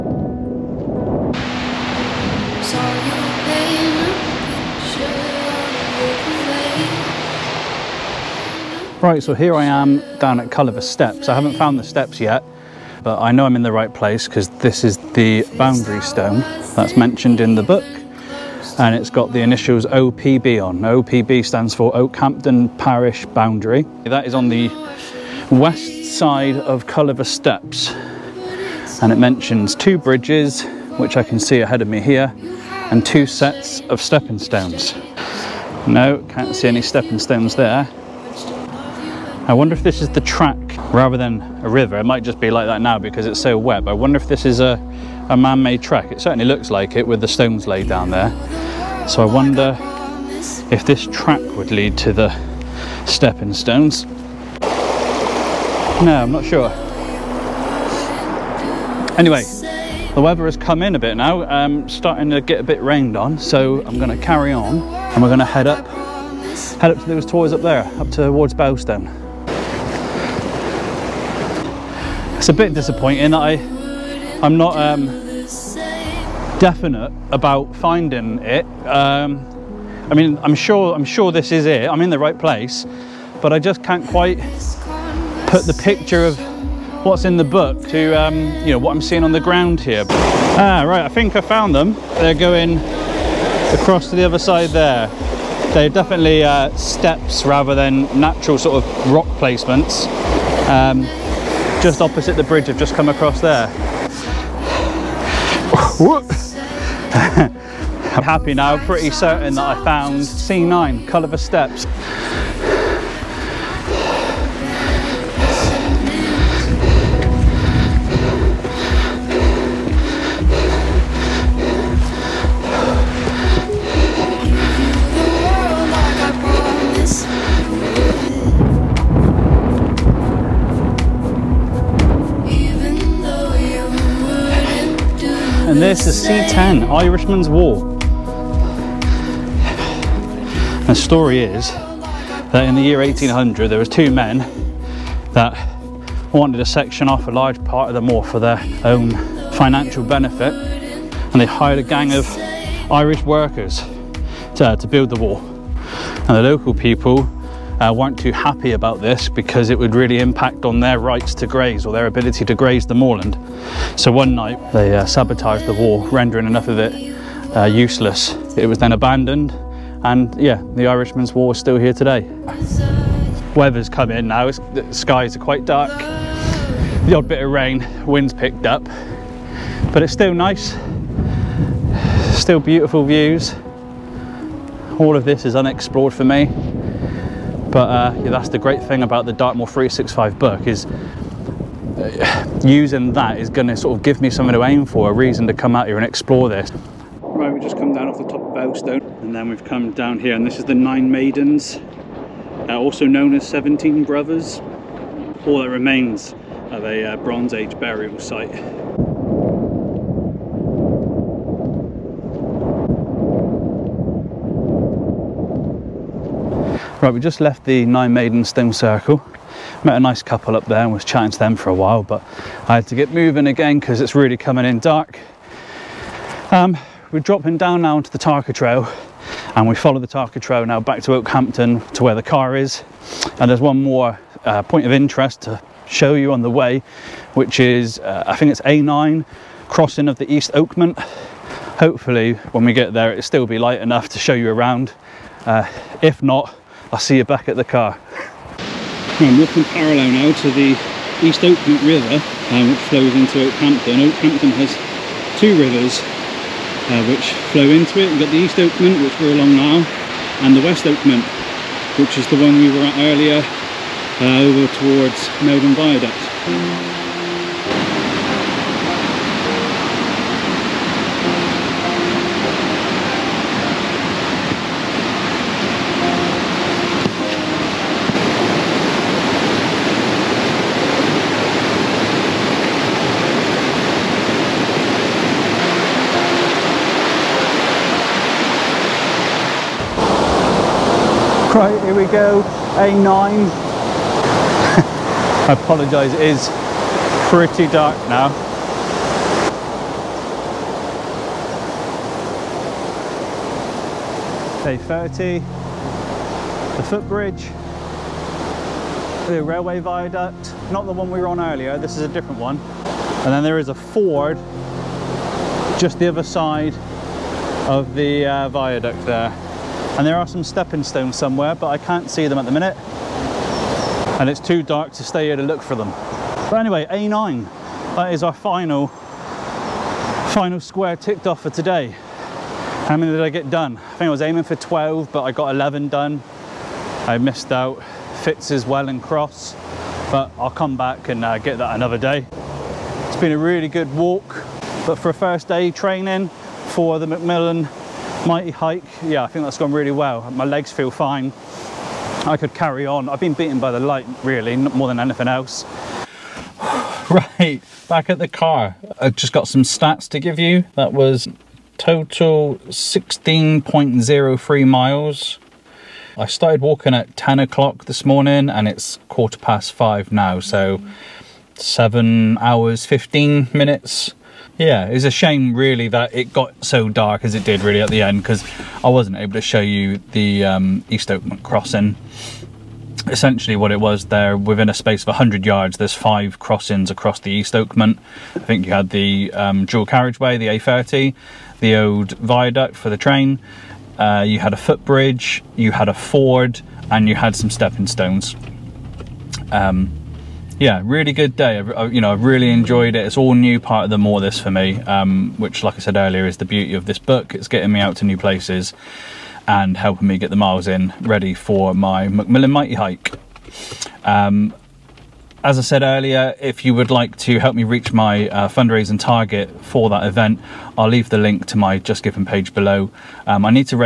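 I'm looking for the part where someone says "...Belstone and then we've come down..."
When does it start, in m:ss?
3:18.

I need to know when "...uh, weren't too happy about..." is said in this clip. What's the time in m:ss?
2:37.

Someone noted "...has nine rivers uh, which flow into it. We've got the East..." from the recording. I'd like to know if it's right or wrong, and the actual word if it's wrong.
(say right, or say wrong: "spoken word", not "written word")
wrong: "two", not "nine".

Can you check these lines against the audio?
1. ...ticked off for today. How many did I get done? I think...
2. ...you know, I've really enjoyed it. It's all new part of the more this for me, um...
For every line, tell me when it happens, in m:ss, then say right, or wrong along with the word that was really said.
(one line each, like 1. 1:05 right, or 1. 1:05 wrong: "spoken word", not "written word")
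1. 5:30 right
2. 6:41 right.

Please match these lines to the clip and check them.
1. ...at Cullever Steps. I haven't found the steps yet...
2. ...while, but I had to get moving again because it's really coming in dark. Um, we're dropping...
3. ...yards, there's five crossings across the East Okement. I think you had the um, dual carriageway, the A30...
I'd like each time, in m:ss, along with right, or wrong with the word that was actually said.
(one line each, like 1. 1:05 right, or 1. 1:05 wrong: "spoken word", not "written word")
1. 0:10 right
2. 3:41 right
3. 6:25 right.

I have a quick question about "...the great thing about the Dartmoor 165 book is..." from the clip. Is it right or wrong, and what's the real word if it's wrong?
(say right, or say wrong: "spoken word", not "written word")
wrong: "365", not "165".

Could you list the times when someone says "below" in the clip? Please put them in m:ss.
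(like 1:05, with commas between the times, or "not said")
7:02.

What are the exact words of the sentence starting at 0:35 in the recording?
No, can't see any stepping stones there.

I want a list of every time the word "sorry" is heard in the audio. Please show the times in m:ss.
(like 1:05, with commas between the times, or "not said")
not said.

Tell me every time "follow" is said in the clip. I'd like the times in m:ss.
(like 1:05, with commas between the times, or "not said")
3:49.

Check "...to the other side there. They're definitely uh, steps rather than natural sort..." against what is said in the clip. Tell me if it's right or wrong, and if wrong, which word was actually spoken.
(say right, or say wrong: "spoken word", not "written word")
right.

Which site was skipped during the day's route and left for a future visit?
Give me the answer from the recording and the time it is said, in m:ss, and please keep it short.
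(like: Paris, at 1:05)
Fitz's well and cross, at 5:38.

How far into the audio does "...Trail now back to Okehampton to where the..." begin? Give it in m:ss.
3:50.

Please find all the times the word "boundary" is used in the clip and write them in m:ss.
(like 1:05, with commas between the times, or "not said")
0:15, 0:23.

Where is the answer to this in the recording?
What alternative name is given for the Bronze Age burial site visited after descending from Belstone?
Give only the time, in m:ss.
3:23.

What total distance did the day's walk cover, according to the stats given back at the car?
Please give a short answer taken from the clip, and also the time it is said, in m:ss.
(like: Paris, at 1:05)
16.03 miles, at 6:02.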